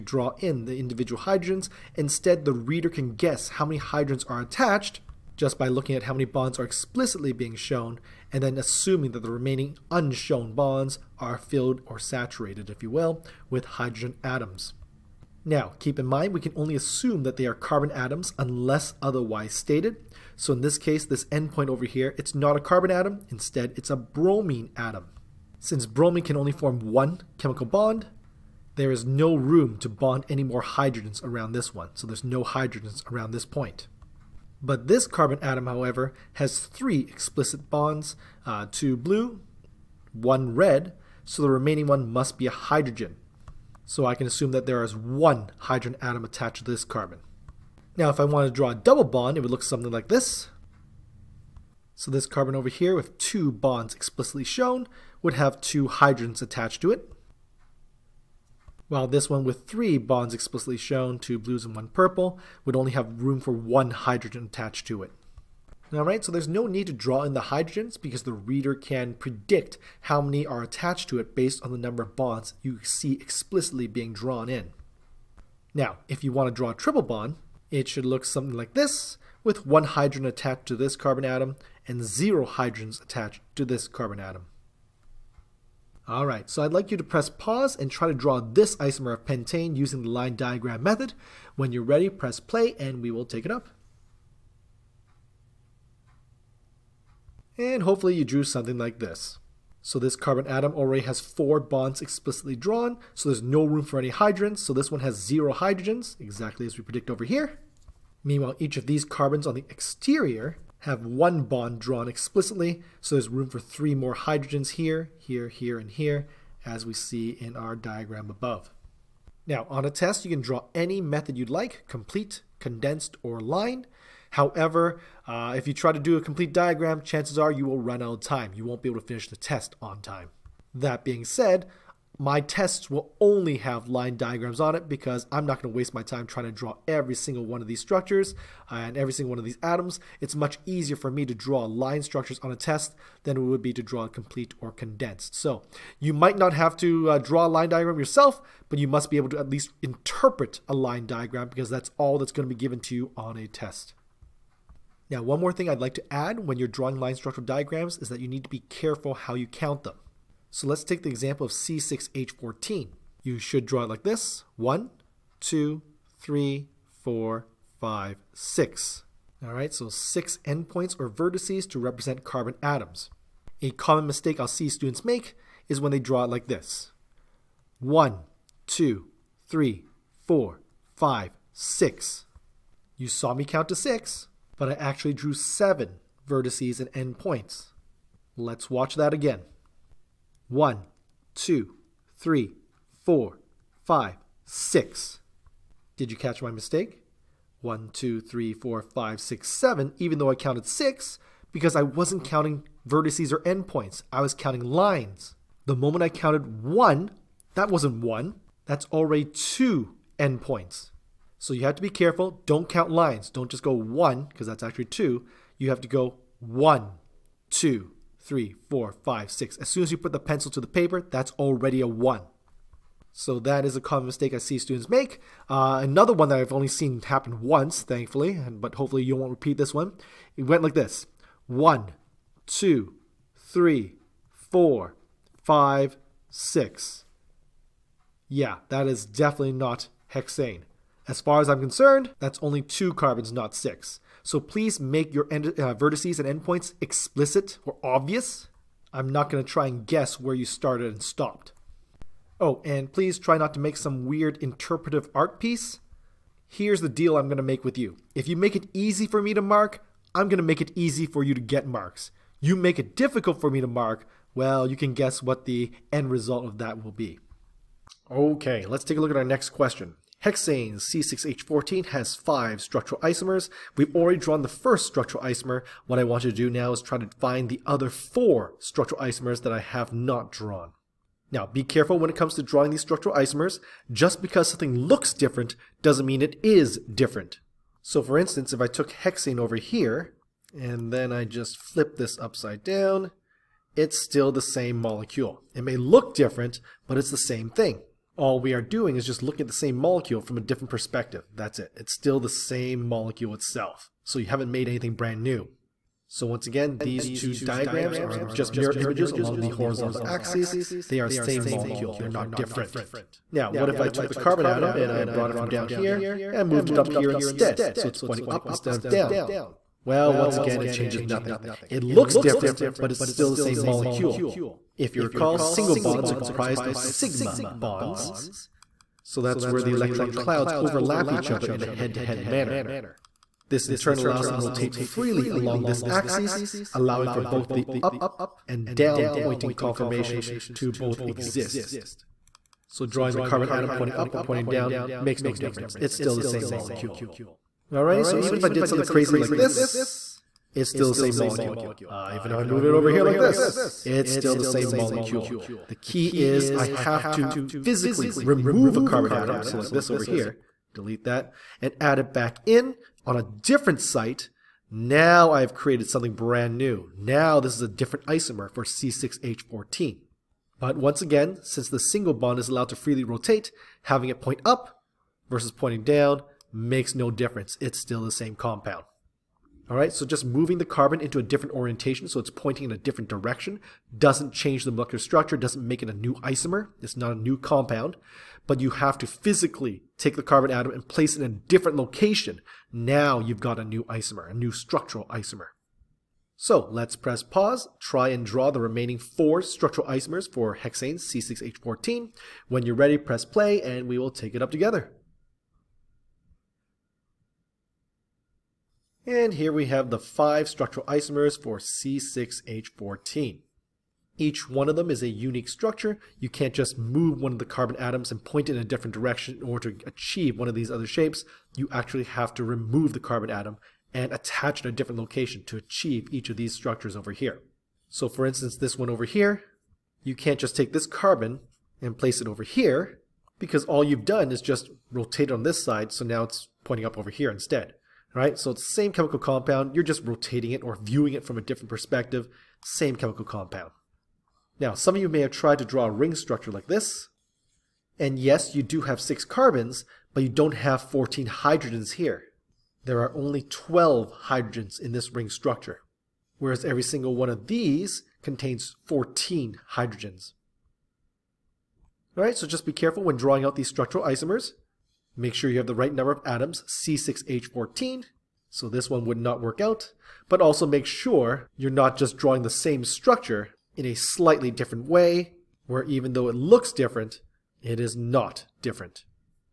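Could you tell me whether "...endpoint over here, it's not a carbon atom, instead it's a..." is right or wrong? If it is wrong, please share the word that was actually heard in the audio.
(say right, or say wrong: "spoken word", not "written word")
right.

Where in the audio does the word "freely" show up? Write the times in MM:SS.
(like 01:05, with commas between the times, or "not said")
05:34, 06:12.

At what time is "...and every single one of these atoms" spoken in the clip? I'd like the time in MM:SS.
02:18.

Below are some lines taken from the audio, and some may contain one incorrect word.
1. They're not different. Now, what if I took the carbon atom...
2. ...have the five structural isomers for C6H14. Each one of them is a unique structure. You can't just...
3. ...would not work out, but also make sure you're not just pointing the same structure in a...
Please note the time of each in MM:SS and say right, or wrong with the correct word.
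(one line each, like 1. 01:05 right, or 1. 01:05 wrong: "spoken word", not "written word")
1. 05:11 right
2. 06:49 right
3. 07:49 wrong: "drawing", not "pointing".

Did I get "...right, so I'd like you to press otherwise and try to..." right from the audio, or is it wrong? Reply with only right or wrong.
wrong.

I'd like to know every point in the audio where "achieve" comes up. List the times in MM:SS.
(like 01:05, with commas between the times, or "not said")
06:59, 07:05.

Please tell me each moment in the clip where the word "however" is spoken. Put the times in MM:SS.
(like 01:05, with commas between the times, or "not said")
00:35, 02:04.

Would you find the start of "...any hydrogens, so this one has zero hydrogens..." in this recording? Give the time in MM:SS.
01:43.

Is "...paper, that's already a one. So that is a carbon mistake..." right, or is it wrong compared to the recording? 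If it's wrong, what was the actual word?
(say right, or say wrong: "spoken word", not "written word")
wrong: "common", not "carbon".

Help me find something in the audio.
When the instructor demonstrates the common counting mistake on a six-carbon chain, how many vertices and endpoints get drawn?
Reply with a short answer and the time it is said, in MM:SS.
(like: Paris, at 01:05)
7, at 03:05.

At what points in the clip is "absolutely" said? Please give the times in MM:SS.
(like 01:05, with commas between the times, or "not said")
not said.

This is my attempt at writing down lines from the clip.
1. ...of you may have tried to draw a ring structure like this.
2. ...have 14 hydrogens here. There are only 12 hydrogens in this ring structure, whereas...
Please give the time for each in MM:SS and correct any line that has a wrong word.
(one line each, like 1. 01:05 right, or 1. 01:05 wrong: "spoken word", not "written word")
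1. 07:24 right
2. 07:30 right.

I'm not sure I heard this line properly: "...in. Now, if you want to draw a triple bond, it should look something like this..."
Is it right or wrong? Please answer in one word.
right.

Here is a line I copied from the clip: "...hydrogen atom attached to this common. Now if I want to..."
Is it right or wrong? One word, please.
wrong.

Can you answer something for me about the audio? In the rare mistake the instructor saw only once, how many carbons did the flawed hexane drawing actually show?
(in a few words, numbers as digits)
2.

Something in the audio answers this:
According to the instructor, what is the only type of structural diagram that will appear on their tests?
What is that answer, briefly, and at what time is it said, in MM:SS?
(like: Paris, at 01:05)
Line diagrams, at 02:13.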